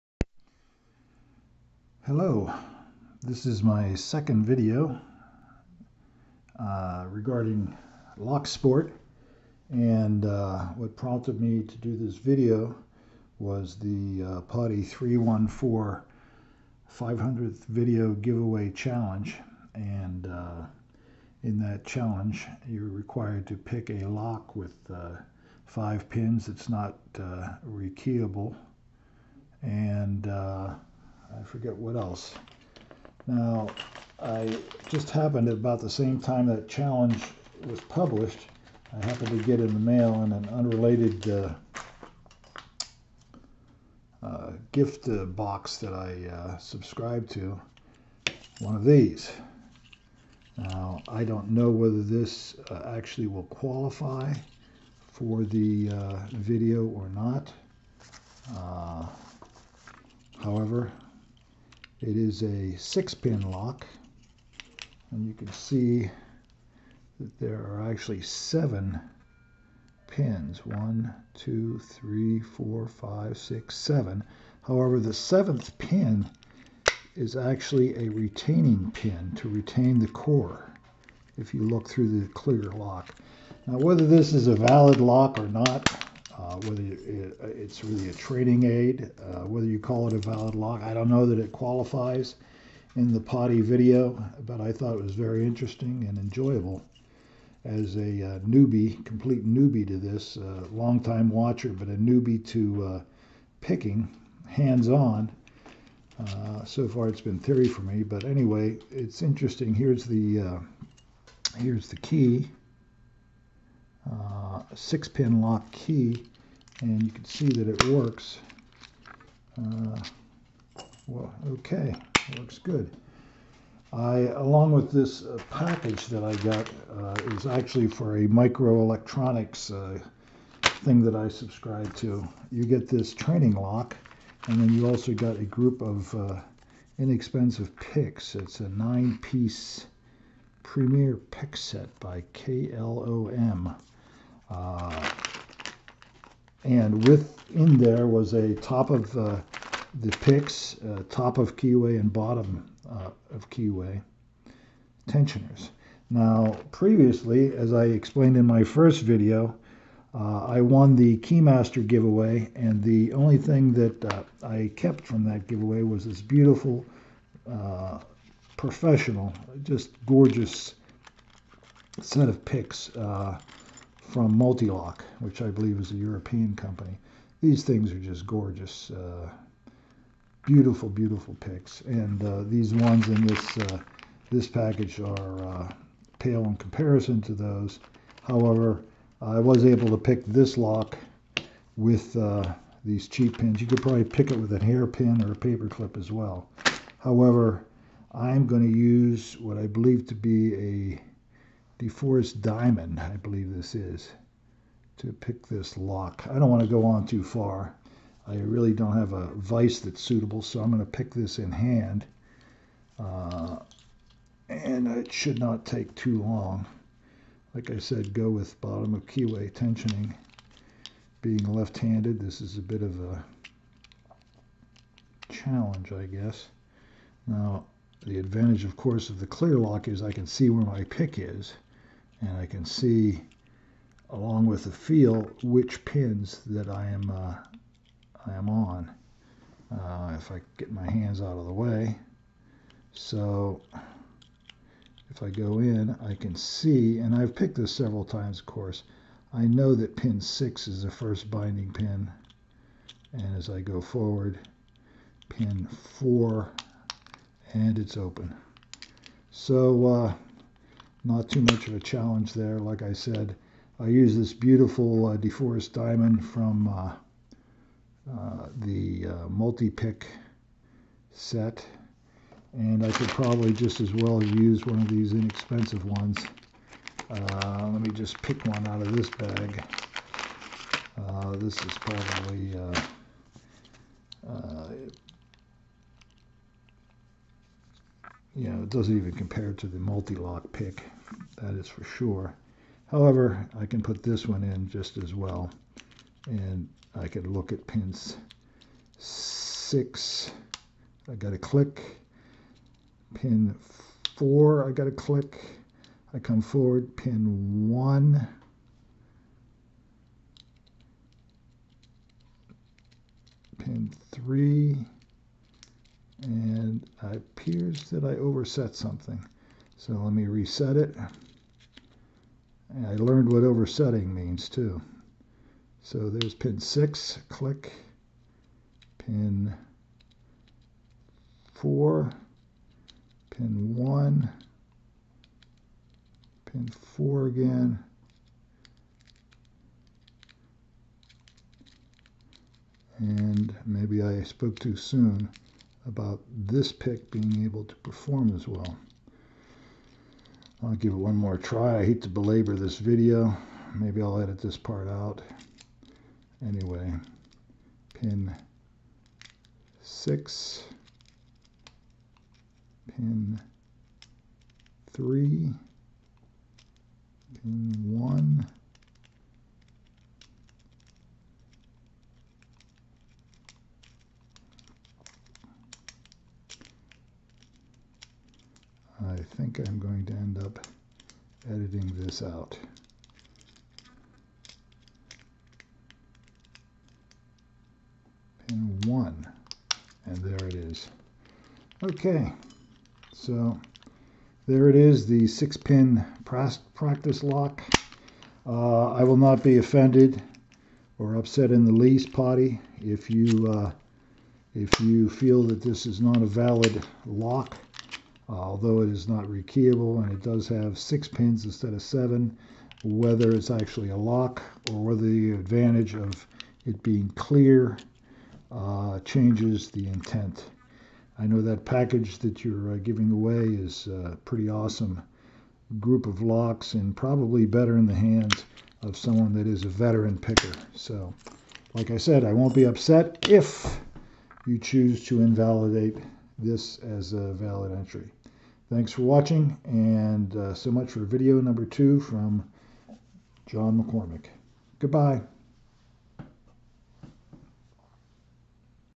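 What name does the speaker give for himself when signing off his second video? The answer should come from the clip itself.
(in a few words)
John McCormick.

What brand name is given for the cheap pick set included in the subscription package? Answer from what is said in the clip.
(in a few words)
KLOM.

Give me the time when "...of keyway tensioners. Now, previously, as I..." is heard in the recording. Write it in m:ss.
2:33.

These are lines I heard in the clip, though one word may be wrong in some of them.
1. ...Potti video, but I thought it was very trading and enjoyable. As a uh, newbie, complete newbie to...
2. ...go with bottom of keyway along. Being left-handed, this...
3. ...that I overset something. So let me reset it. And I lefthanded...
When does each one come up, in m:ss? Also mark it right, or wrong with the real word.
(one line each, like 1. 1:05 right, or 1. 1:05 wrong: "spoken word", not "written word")
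1. 1:33 wrong: "interesting", not "trading"
2. 3:38 wrong: "tensioning", not "along"
3. 5:17 wrong: "learned", not "lefthanded".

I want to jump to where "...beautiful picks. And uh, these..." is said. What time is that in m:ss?
3:00.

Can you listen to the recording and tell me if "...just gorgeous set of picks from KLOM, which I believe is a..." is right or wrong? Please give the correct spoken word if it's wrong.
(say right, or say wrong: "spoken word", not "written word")
wrong: "Multilock", not "KLOM".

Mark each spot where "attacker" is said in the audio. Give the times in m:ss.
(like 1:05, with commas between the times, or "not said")
not said.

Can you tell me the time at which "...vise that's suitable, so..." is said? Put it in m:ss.
3:29.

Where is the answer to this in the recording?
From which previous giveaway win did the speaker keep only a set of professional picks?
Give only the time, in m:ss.
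2:41.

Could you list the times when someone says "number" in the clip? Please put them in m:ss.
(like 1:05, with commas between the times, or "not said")
7:21.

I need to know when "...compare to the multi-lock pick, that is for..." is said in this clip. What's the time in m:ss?
4:49.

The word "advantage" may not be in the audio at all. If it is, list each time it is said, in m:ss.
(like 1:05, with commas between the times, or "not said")
3:48, 6:55.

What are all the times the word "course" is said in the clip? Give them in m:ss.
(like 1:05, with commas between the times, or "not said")
3:48, 4:08.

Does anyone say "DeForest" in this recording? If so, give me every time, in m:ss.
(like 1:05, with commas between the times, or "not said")
3:21, 4:25.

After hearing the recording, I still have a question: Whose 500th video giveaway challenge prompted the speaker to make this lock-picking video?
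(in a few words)
Potti 314.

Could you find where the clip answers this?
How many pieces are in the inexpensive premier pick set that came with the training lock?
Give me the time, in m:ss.
2:18.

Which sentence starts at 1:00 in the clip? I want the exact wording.
however, it is a six pin lock and you can see that there are actually seven pins.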